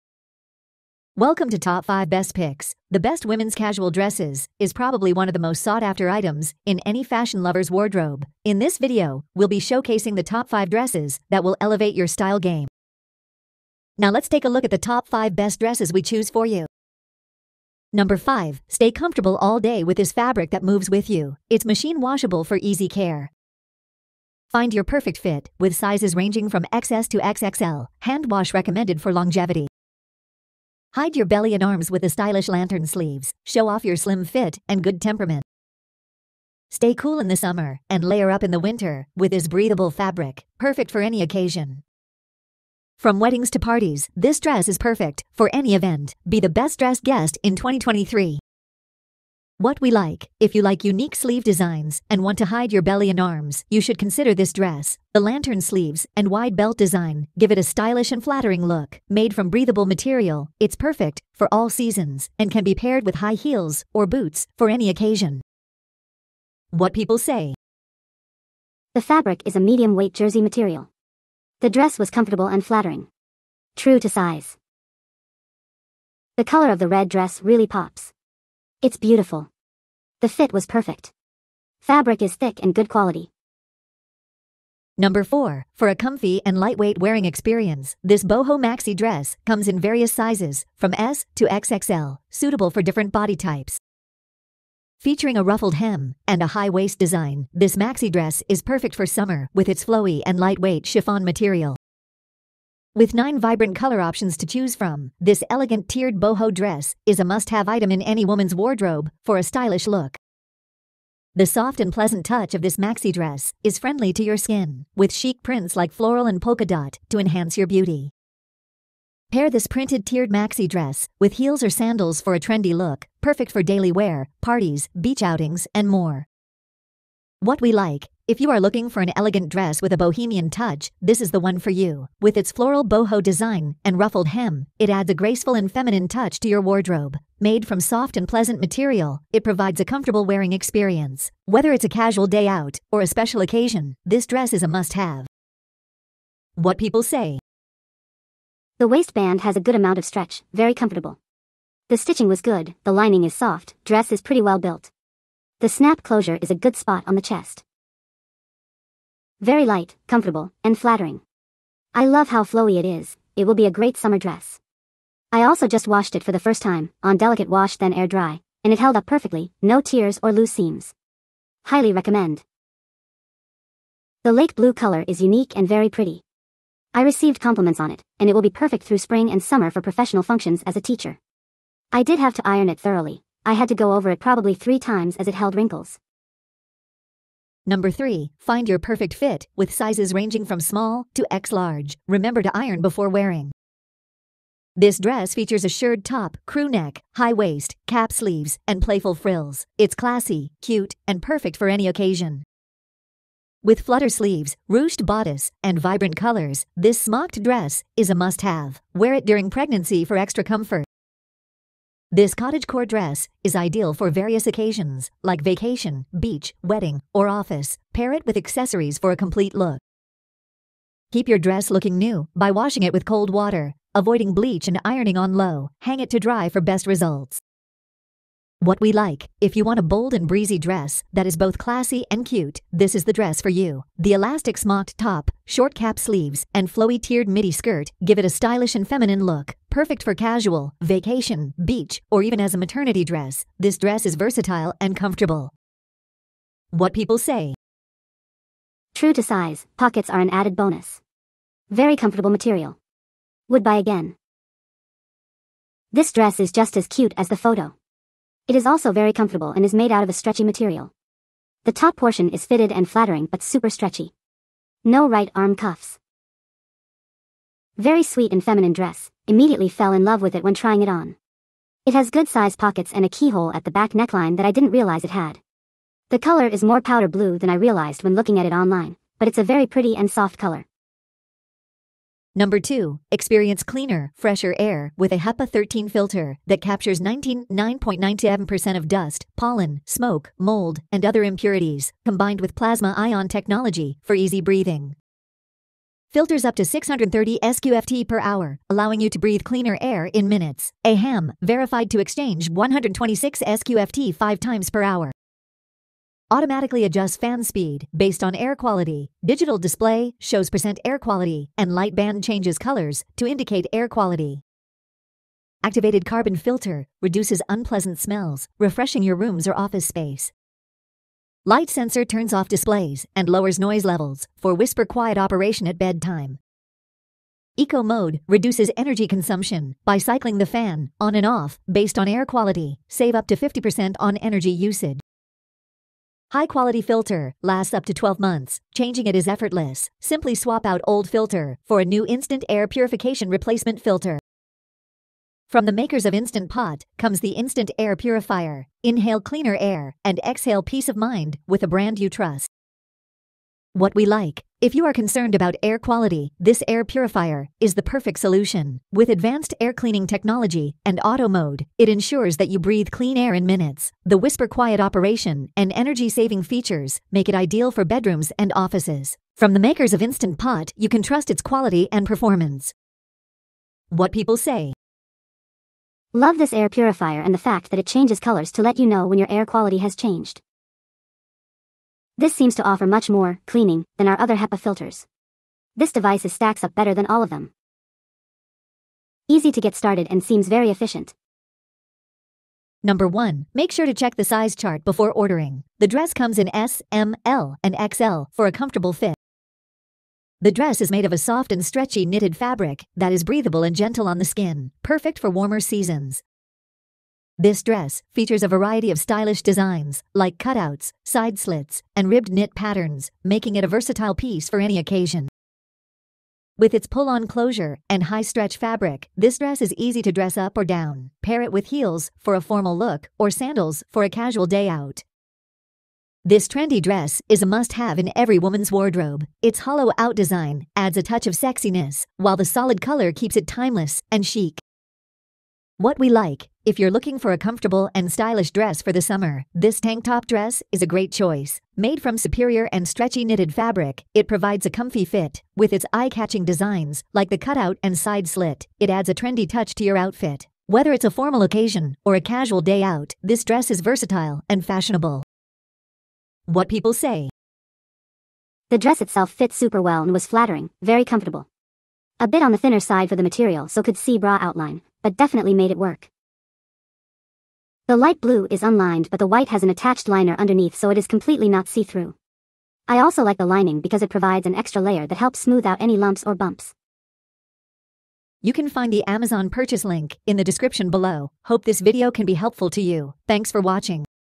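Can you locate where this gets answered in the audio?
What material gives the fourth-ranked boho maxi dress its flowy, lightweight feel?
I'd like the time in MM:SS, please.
01:40.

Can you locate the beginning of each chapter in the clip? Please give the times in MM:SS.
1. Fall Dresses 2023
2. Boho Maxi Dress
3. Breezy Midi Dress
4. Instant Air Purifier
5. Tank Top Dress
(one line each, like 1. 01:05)
1. 00:16
2. 01:23
3. 03:06
4. 04:41
5. 06:31.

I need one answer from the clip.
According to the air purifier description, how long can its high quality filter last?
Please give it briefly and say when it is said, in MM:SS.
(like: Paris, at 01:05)
12 months, at 05:37.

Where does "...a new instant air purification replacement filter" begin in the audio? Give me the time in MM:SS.
05:41.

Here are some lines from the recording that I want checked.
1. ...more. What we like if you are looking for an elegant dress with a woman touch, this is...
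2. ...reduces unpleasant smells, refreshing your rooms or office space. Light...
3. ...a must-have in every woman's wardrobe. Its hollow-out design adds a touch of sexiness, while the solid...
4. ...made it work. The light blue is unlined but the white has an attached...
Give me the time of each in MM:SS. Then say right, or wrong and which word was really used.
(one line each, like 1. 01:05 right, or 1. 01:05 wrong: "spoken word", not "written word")
1. 02:05 wrong: "bohemian", not "woman"
2. 05:17 right
3. 07:07 right
4. 07:45 right.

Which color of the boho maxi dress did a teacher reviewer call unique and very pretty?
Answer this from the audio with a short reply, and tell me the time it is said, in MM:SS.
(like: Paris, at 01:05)
Lake blue, at 02:54.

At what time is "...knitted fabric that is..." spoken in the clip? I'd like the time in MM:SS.
06:42.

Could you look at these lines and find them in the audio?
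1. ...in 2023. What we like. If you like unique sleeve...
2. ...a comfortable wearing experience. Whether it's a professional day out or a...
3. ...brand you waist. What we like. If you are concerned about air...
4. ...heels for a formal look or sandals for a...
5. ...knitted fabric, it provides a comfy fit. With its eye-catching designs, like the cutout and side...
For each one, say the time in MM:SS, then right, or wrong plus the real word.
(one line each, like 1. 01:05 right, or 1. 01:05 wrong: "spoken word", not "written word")
1. 00:47 right
2. 02:19 wrong: "casual", not "professional"
3. 05:51 wrong: "trust", not "waist"
4. 07:01 right
5. 07:23 right.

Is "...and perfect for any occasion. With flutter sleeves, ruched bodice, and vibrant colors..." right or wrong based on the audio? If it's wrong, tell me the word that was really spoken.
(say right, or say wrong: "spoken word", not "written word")
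right.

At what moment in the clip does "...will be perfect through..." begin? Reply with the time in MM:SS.
02:58.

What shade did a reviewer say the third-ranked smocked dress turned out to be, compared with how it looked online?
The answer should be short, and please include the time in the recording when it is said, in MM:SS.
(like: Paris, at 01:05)
Powder blue, at 04:36.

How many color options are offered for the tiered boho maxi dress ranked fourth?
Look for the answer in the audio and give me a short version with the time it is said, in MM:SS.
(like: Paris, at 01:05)
9, at 01:43.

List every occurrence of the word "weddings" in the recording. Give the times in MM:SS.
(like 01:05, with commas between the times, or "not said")
00:43, 03:36.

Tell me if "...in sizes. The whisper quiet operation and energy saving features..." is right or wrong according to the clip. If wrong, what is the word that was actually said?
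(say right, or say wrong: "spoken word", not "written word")
wrong: "minutes", not "sizes".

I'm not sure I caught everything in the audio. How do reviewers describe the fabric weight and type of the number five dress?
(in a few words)
Medium weight jersey.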